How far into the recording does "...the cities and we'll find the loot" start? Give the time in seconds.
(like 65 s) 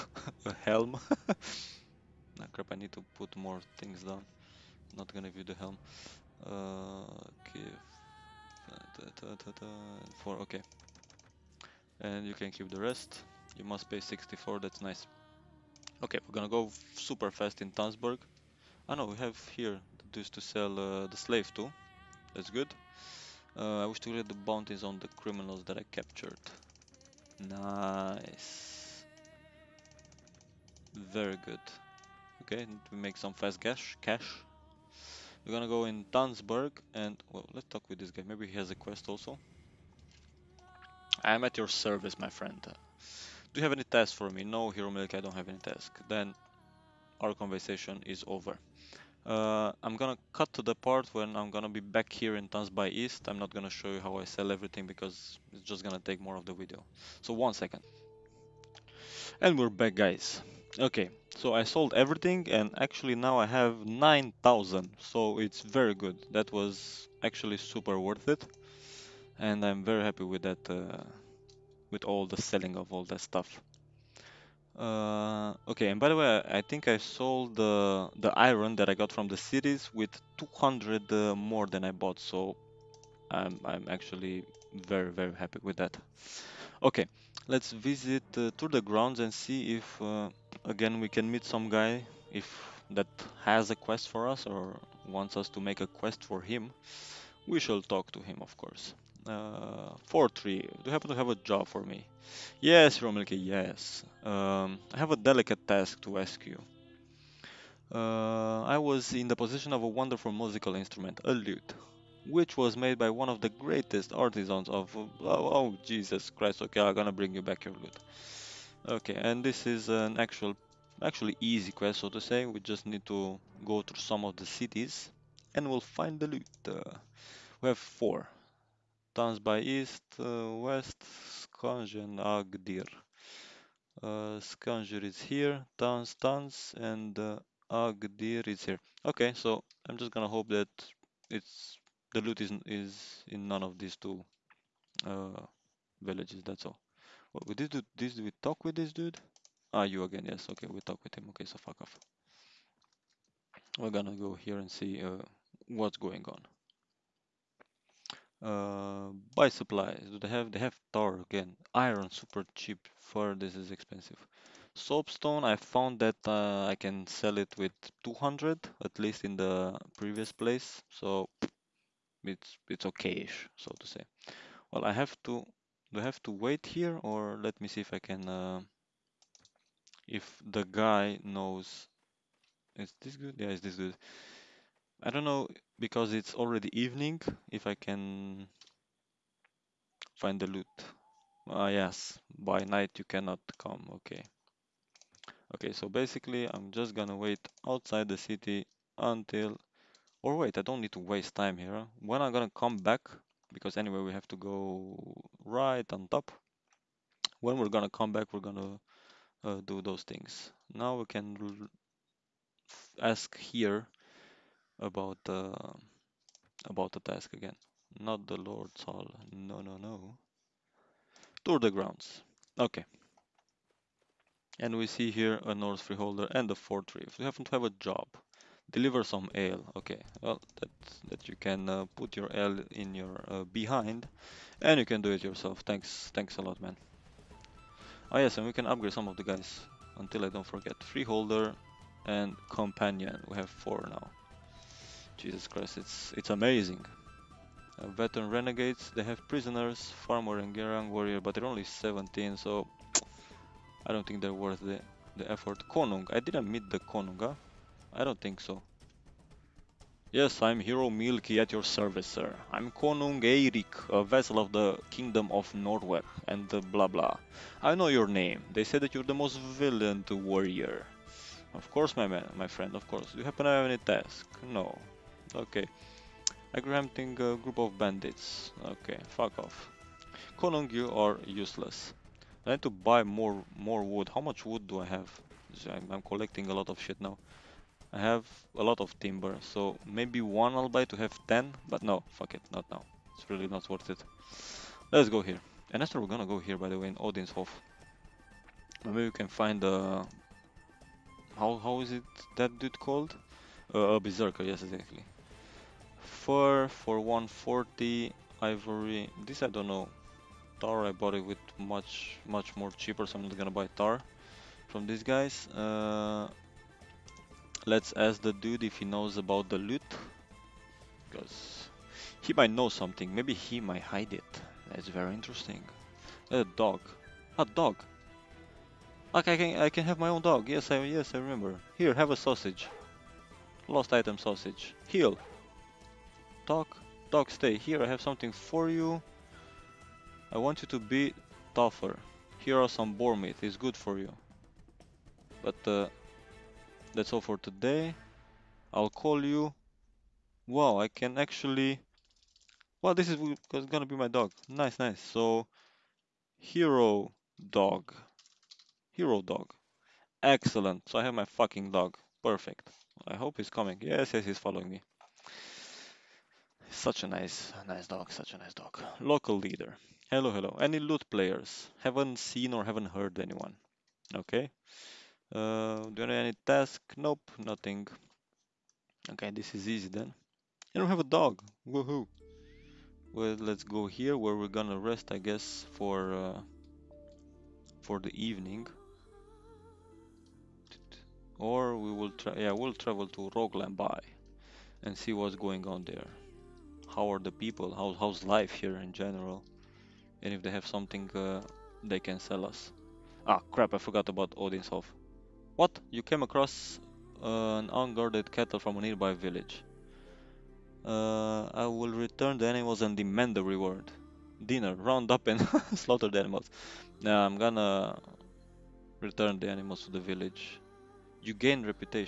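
124 s.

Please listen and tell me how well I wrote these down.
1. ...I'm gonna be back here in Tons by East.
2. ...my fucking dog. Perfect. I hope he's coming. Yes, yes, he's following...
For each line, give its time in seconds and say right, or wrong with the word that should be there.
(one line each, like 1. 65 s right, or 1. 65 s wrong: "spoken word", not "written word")
1. 51 s right
2. 361 s right.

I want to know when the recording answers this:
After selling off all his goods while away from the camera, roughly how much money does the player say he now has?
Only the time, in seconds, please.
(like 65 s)
63 s.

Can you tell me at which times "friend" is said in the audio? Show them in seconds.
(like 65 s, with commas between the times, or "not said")
42 s, 272 s.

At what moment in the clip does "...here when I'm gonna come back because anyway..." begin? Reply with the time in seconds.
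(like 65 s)
201 s.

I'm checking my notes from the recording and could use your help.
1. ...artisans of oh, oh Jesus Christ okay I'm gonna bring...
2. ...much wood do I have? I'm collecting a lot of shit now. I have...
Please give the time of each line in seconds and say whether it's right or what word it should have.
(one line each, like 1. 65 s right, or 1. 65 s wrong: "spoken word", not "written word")
1. 114 s right
2. 284 s right.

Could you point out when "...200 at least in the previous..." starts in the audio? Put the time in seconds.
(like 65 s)
168 s.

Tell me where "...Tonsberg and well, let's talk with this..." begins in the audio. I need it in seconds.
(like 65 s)
36 s.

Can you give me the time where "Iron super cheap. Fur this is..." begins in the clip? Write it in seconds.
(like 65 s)
161 s.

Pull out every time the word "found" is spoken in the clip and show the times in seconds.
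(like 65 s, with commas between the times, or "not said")
165 s.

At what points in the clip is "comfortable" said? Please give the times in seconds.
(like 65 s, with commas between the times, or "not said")
not said.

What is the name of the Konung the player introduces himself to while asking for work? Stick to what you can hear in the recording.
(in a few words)
Eirik.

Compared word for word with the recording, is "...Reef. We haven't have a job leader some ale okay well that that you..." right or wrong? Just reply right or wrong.
wrong.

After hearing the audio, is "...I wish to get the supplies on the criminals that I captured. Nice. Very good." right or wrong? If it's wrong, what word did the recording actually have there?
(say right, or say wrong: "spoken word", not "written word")
wrong: "bounties", not "supplies".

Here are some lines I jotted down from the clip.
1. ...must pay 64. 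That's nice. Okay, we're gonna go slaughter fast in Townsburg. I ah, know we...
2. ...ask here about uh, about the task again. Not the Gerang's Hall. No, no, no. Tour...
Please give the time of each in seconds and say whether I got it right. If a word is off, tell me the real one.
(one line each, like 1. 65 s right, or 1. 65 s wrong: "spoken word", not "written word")
1. 13 s wrong: "super", not "slaughter"
2. 213 s wrong: "Lord", not "Gerang".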